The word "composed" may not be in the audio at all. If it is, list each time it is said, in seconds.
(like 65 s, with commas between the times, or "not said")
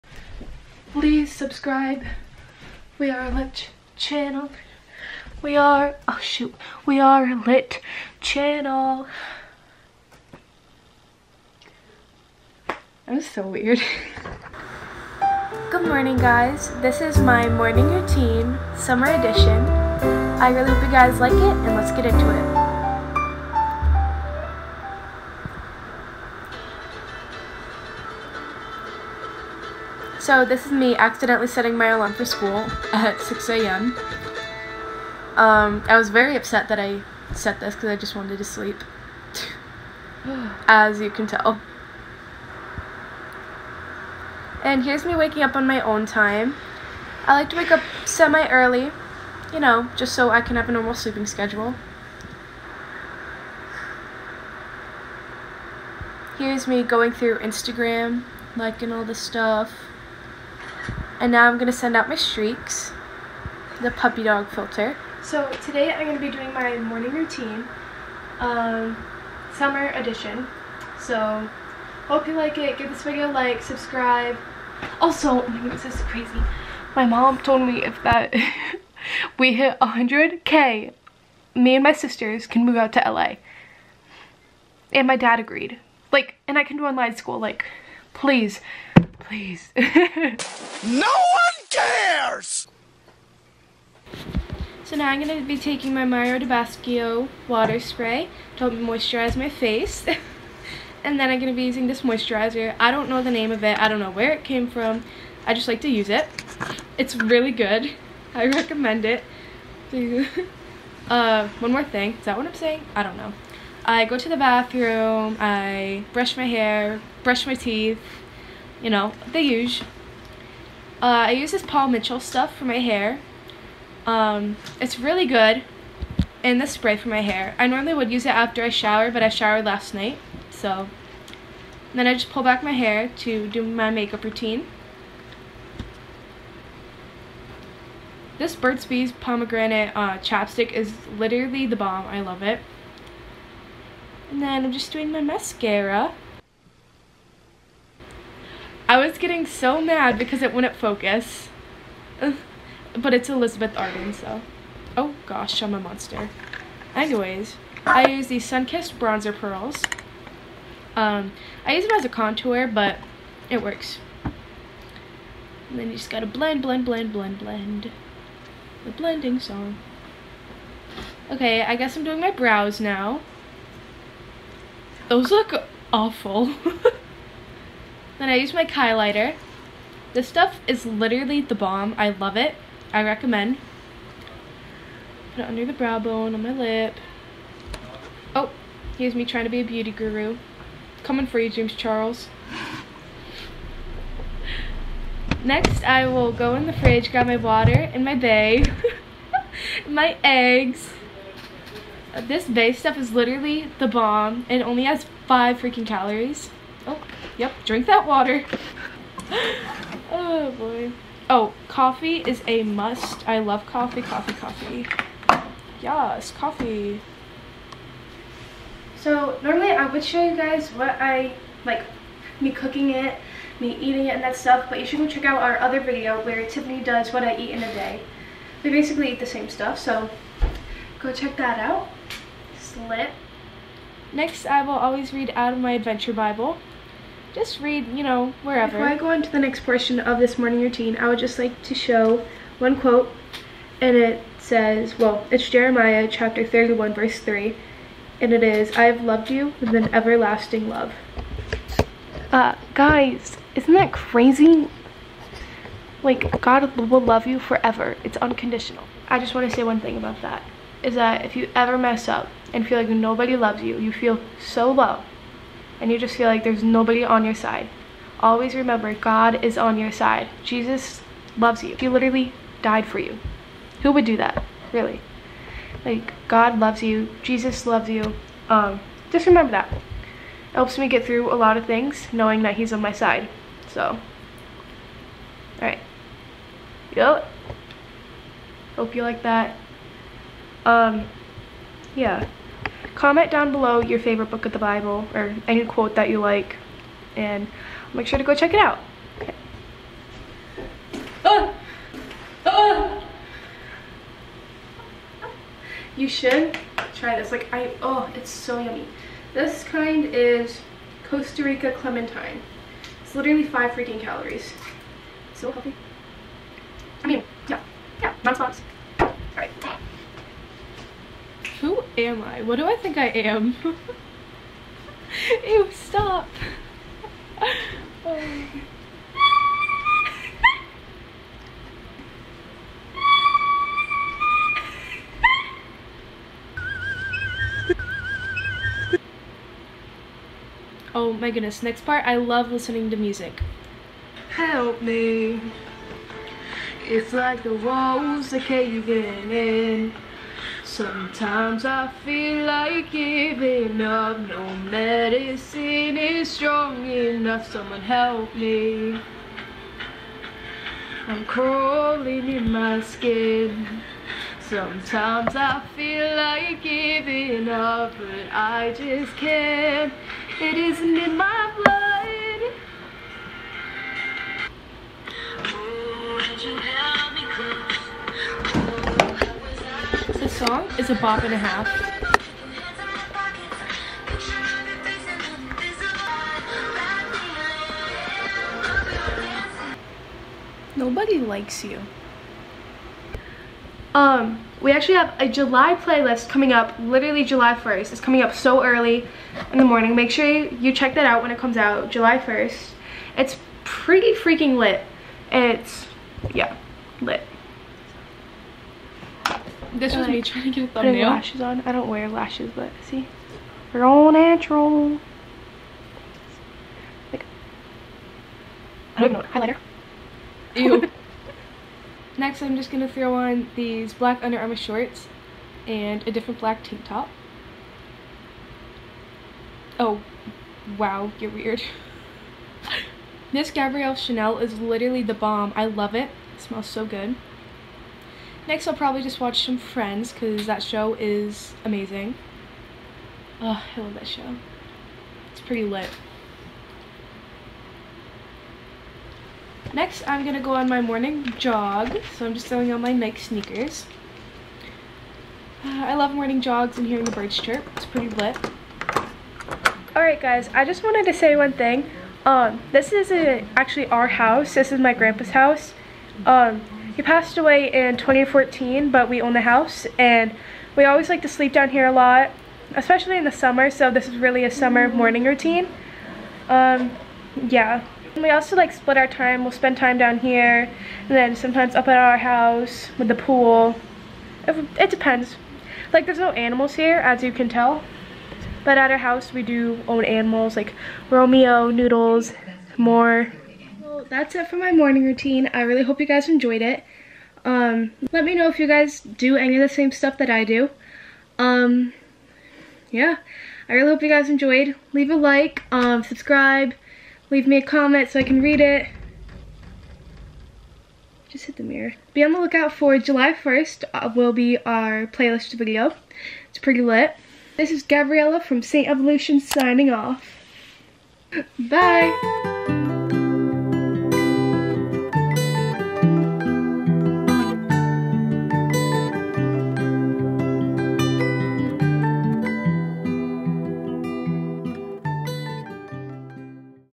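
not said.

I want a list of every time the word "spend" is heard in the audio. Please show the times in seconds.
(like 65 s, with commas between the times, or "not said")
479 s.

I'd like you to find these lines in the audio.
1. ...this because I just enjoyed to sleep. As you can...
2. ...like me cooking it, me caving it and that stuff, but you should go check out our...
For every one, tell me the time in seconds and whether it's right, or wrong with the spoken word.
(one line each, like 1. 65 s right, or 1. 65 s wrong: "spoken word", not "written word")
1. 37 s wrong: "wanted", not "enjoyed"
2. 221 s wrong: "eating", not "caving".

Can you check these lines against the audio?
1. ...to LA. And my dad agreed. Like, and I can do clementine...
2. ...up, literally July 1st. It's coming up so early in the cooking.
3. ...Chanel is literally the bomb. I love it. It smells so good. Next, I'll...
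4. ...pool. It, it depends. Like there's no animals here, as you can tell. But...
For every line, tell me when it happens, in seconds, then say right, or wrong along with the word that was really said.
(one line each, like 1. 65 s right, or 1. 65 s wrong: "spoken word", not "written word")
1. 82 s wrong: "online", not "clementine"
2. 396 s wrong: "morning", not "cooking"
3. 433 s right
4. 483 s right.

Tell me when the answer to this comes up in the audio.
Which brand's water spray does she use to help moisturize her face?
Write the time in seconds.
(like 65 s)
96 s.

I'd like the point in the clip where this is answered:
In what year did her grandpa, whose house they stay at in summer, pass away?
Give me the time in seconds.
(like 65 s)
467 s.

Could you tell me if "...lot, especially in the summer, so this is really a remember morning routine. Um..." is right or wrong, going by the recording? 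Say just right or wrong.
wrong.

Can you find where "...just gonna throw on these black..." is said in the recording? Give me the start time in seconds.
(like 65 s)
422 s.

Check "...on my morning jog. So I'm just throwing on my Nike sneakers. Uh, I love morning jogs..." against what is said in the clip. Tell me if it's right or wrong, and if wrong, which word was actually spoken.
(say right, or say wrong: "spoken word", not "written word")
right.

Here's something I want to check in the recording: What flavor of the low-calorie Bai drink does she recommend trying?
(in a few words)
Costa Rica clementine.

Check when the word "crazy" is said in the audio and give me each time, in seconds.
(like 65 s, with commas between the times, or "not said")
76 s, 253 s.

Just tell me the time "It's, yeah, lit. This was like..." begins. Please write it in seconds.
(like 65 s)
405 s.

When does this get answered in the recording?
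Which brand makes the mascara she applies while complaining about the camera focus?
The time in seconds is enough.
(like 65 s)
153 s.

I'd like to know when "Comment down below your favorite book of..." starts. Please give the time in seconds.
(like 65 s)
293 s.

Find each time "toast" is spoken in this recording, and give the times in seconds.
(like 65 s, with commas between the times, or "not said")
not said.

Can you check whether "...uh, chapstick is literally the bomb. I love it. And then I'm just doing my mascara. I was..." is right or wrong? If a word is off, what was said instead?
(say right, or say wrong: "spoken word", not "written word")
right.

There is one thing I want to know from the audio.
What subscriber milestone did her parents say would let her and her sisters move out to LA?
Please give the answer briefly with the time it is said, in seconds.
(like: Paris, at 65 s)
100k, at 79 s.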